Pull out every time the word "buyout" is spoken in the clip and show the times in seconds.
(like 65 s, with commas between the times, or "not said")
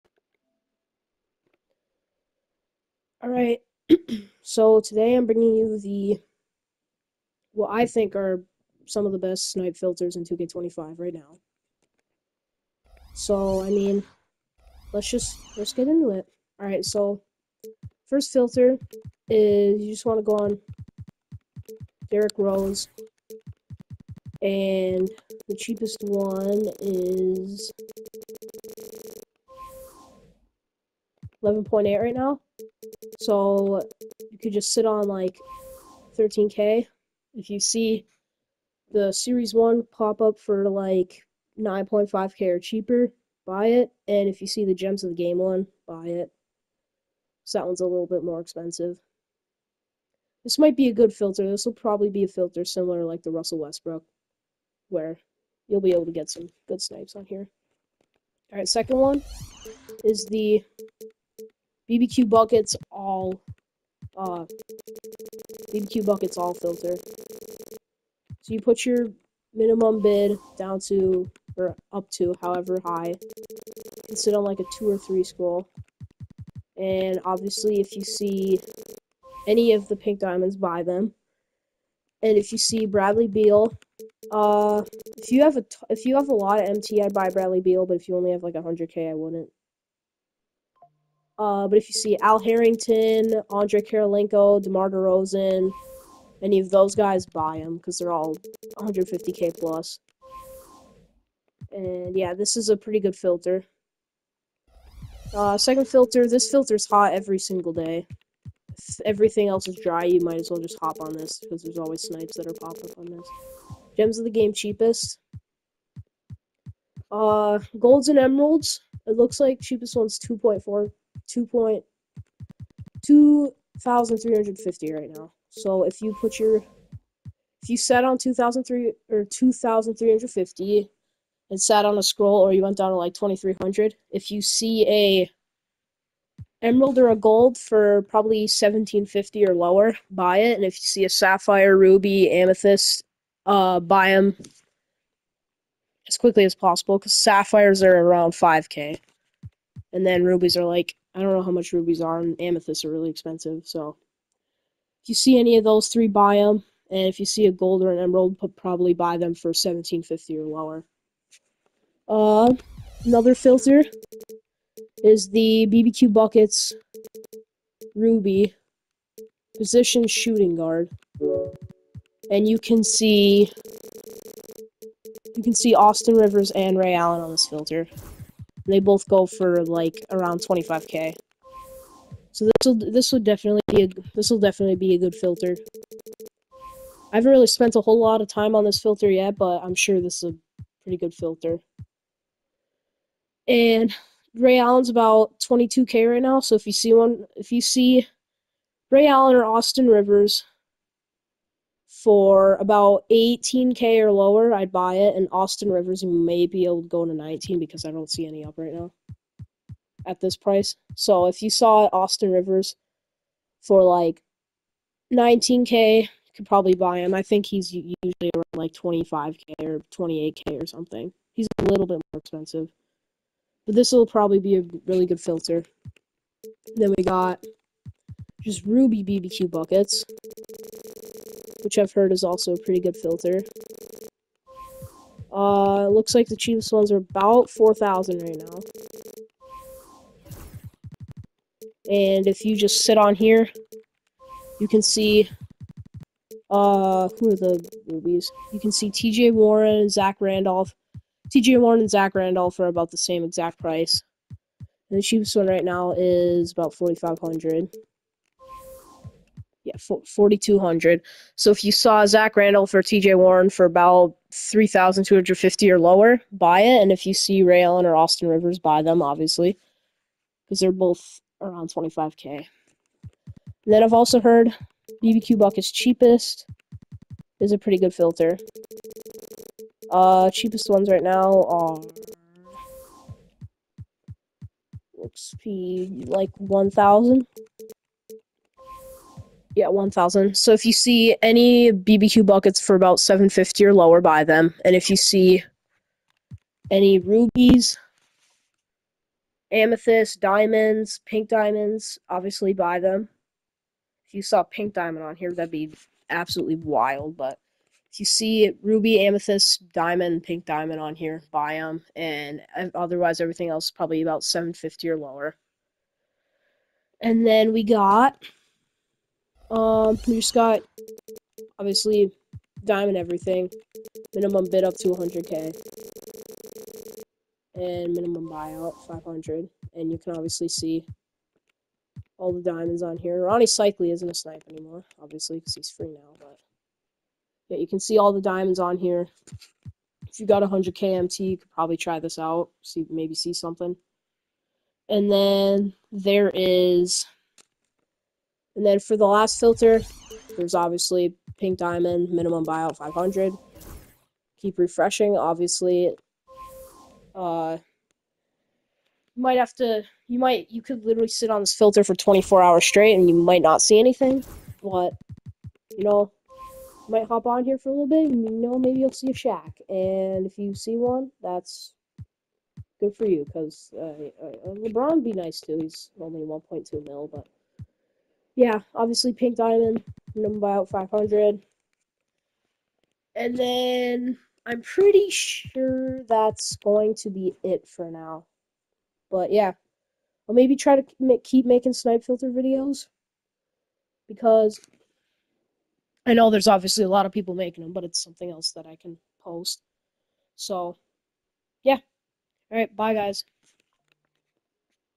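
328 s, 352 s.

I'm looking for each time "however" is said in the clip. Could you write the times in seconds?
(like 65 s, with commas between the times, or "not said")
72 s.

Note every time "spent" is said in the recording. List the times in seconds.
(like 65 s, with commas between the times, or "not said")
187 s.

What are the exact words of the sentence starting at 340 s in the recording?
If you got 100k MT, you could probably try this out.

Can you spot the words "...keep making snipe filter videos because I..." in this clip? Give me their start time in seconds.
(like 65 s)
391 s.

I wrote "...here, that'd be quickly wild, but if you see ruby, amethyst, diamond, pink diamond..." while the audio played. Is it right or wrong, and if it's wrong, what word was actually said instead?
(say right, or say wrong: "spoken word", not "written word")
wrong: "absolutely", not "quickly".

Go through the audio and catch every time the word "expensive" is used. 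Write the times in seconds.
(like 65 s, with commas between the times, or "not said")
48 s, 153 s, 222 s.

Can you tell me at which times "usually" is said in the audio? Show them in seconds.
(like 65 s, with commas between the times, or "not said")
217 s.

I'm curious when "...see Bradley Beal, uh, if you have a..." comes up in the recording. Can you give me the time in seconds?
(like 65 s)
82 s.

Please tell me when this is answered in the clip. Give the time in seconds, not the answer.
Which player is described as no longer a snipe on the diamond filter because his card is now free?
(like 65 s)
333 s.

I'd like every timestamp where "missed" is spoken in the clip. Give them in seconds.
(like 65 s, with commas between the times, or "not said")
not said.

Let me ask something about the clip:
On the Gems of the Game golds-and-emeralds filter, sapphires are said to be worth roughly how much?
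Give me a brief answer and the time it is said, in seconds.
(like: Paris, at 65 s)
5k, at 148 s.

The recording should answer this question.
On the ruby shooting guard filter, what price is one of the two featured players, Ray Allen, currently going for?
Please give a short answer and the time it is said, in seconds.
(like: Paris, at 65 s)
22k, at 195 s.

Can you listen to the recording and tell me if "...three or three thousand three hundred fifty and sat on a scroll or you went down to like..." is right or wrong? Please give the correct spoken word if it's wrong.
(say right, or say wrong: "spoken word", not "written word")
wrong: "two", not "three".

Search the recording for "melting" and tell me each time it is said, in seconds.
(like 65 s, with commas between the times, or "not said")
not said.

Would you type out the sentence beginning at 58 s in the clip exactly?
Alright, second one is the BBQ buckets all uh BBQ buckets all filter.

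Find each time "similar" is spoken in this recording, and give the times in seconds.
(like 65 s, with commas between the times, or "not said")
52 s.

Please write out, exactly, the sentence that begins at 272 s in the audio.
And then I've also heard BBQ Bucket's cheapest is a pretty good filter.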